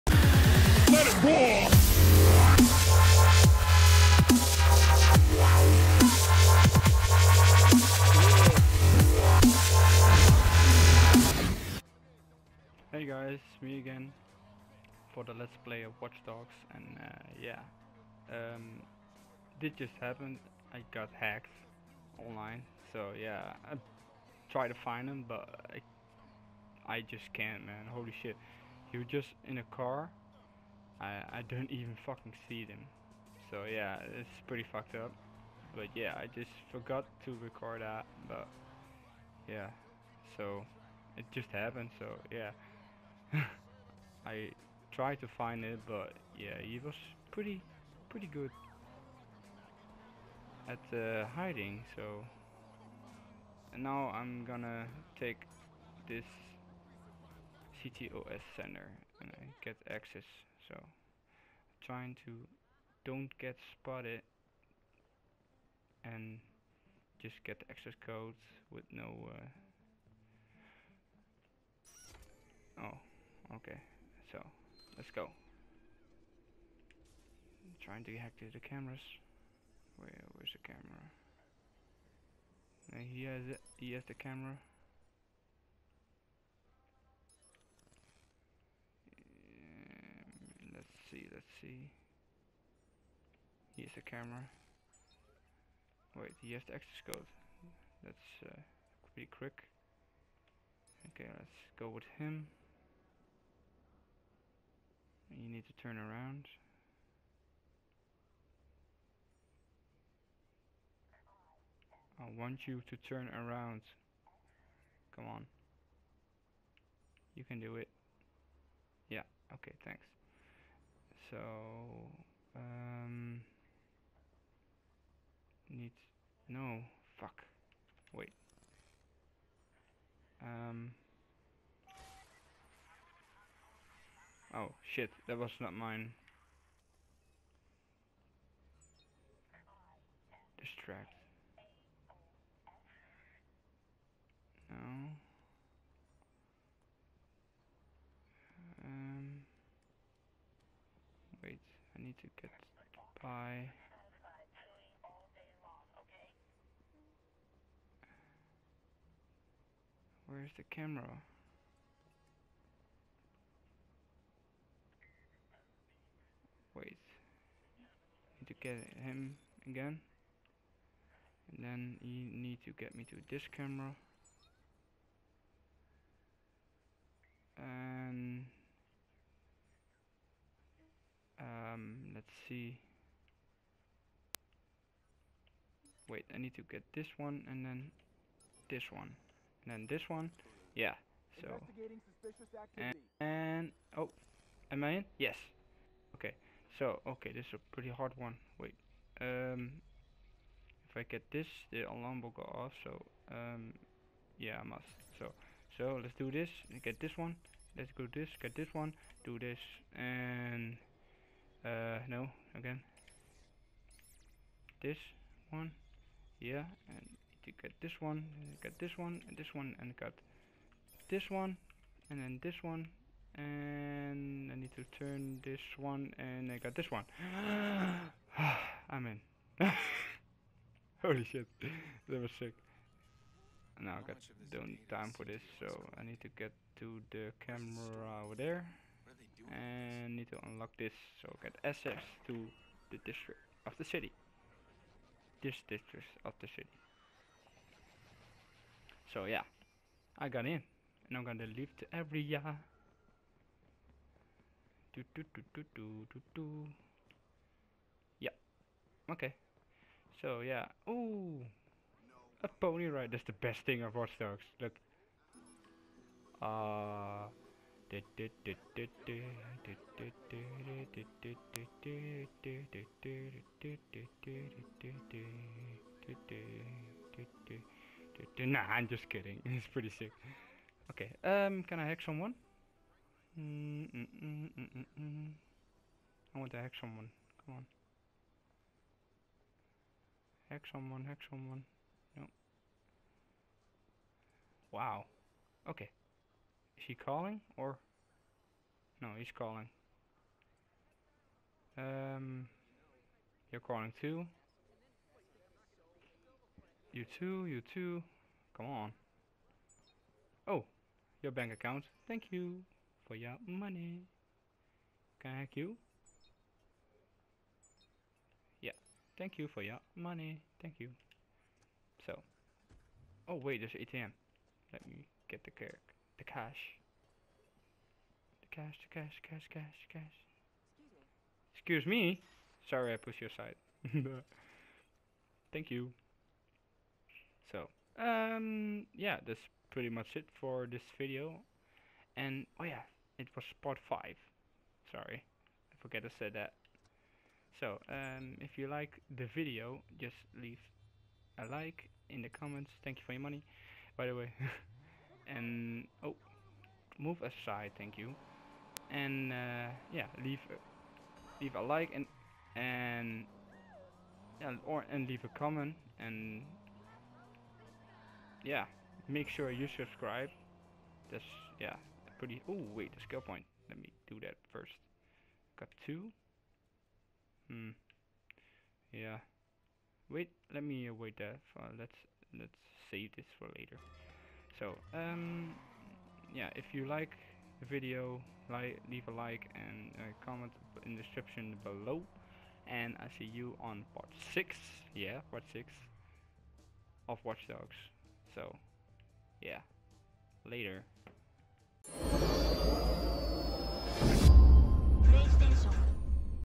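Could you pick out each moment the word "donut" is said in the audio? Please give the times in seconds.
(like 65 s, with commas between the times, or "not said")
not said.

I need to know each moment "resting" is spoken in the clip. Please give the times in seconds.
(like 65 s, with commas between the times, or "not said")
not said.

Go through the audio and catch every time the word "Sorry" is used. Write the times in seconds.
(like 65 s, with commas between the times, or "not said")
332 s, 344 s.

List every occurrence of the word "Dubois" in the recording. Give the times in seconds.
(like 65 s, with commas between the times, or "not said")
not said.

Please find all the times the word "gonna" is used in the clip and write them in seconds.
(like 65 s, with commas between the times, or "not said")
54 s, 251 s.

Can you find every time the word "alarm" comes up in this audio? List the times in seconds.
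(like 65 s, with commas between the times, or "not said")
201 s.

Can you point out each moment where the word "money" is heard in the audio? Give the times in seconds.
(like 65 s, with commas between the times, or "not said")
313 s, 319 s, 353 s.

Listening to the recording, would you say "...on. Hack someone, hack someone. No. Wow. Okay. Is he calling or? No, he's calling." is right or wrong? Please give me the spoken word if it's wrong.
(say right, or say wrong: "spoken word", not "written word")
right.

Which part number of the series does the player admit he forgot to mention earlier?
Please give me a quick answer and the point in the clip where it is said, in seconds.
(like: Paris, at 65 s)
5, at 343 s.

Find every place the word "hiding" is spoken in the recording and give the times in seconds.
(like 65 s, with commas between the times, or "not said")
51 s.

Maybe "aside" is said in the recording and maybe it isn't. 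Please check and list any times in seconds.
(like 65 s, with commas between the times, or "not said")
333 s, 357 s.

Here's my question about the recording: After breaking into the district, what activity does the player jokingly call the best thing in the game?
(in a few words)
a pony ride.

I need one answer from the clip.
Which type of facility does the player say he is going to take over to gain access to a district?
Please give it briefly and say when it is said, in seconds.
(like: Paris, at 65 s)
CTOS center, at 57 s.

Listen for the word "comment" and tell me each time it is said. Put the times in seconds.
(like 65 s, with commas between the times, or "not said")
352 s, 365 s, 390 s.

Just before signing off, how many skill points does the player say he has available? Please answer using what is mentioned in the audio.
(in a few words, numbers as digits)
2.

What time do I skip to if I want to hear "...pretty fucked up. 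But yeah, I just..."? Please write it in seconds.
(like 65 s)
34 s.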